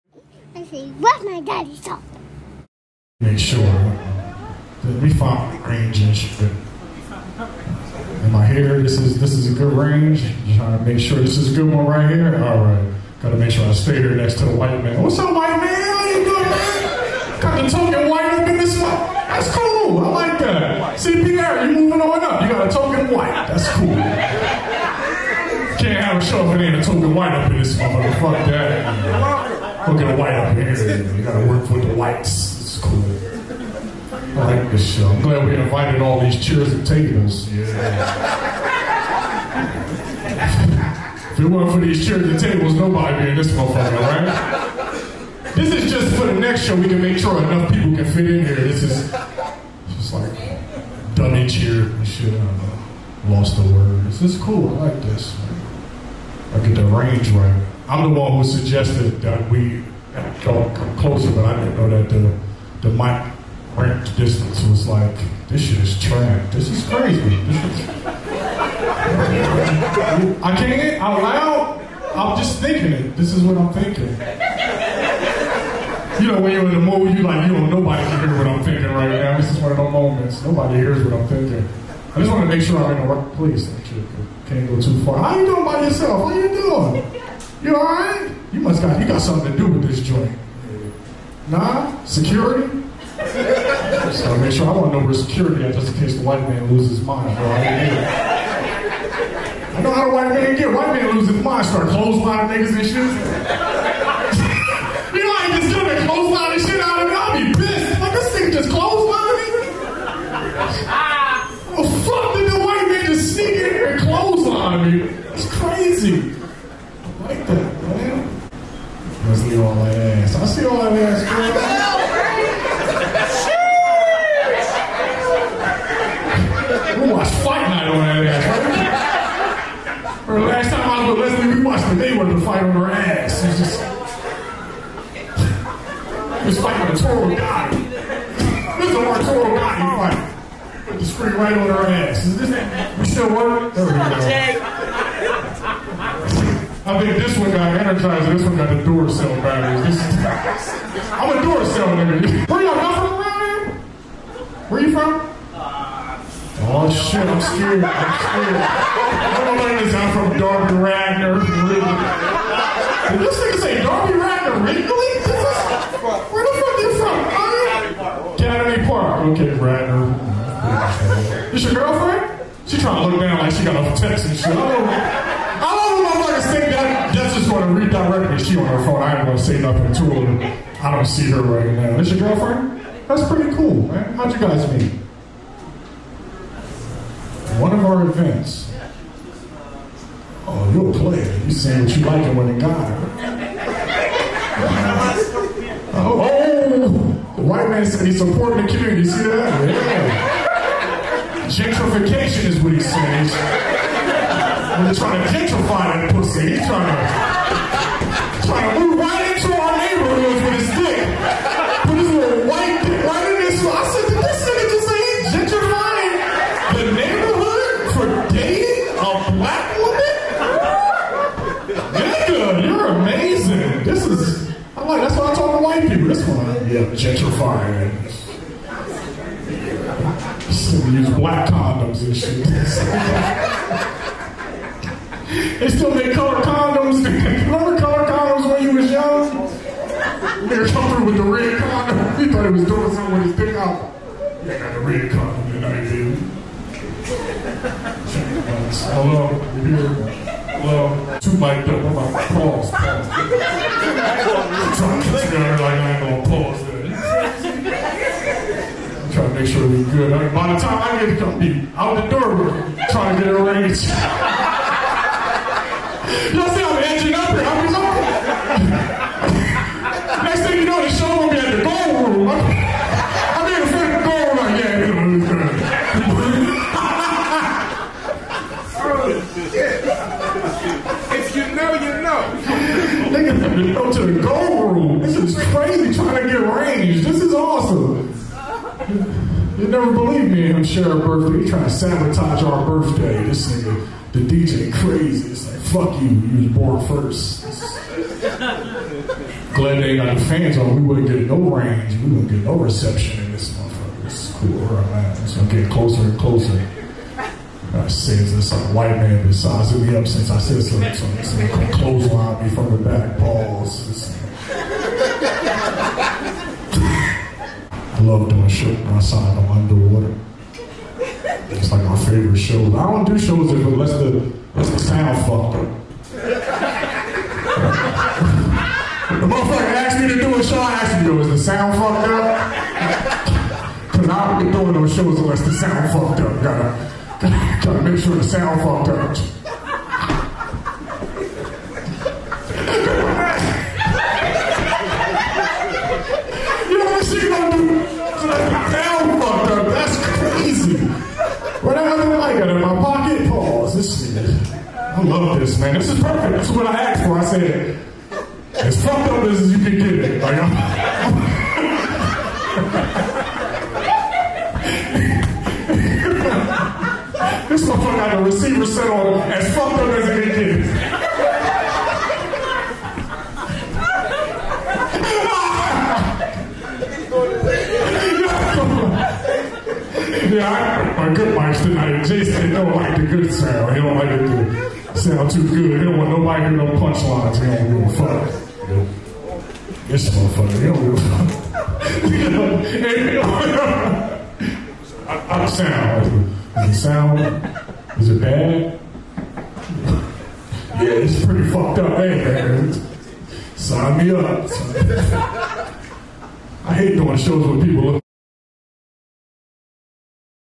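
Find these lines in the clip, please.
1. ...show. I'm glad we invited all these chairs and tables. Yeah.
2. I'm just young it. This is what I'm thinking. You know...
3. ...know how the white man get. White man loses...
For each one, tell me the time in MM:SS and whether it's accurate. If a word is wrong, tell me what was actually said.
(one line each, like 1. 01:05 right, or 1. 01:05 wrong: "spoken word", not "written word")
1. 00:34 right
2. 01:12 wrong: "thinking", not "young"
3. 01:39 right.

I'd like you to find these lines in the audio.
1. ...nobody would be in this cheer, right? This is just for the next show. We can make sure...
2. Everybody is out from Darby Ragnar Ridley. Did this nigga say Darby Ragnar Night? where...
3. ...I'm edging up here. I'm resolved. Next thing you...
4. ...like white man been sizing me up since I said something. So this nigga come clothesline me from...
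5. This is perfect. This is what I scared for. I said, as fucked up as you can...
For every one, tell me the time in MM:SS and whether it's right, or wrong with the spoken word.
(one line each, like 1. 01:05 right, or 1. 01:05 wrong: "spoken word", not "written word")
1. 00:42 wrong: "motherfucker", not "cheer"
2. 02:39 wrong: "Ridley", not "Night"
3. 04:26 right
4. 05:08 right
5. 05:55 wrong: "asked", not "scared".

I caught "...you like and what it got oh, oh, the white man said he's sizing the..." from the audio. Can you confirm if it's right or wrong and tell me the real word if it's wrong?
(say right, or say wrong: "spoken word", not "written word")
wrong: "supporting", not "sizing".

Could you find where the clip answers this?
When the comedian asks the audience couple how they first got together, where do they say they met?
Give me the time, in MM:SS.
03:07.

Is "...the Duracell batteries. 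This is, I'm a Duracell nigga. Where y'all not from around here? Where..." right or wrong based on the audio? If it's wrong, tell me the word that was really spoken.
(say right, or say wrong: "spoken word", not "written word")
right.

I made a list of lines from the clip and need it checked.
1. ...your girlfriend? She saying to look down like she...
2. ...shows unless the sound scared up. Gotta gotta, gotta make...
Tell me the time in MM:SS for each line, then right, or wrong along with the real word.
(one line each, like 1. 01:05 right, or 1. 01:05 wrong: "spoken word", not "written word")
1. 02:51 wrong: "trying", not "saying"
2. 05:34 wrong: "fucked", not "scared".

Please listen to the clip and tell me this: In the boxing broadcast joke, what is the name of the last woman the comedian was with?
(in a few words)
Leslie.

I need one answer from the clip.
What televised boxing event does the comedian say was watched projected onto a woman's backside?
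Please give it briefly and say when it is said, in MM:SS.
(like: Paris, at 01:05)
Fight Night, at 02:07.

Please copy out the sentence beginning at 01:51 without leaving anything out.
Oh, fuck, did the white man just sneak in here and clothesline me?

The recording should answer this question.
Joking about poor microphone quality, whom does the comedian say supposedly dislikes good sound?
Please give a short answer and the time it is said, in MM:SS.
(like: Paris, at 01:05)
Jason, at 06:22.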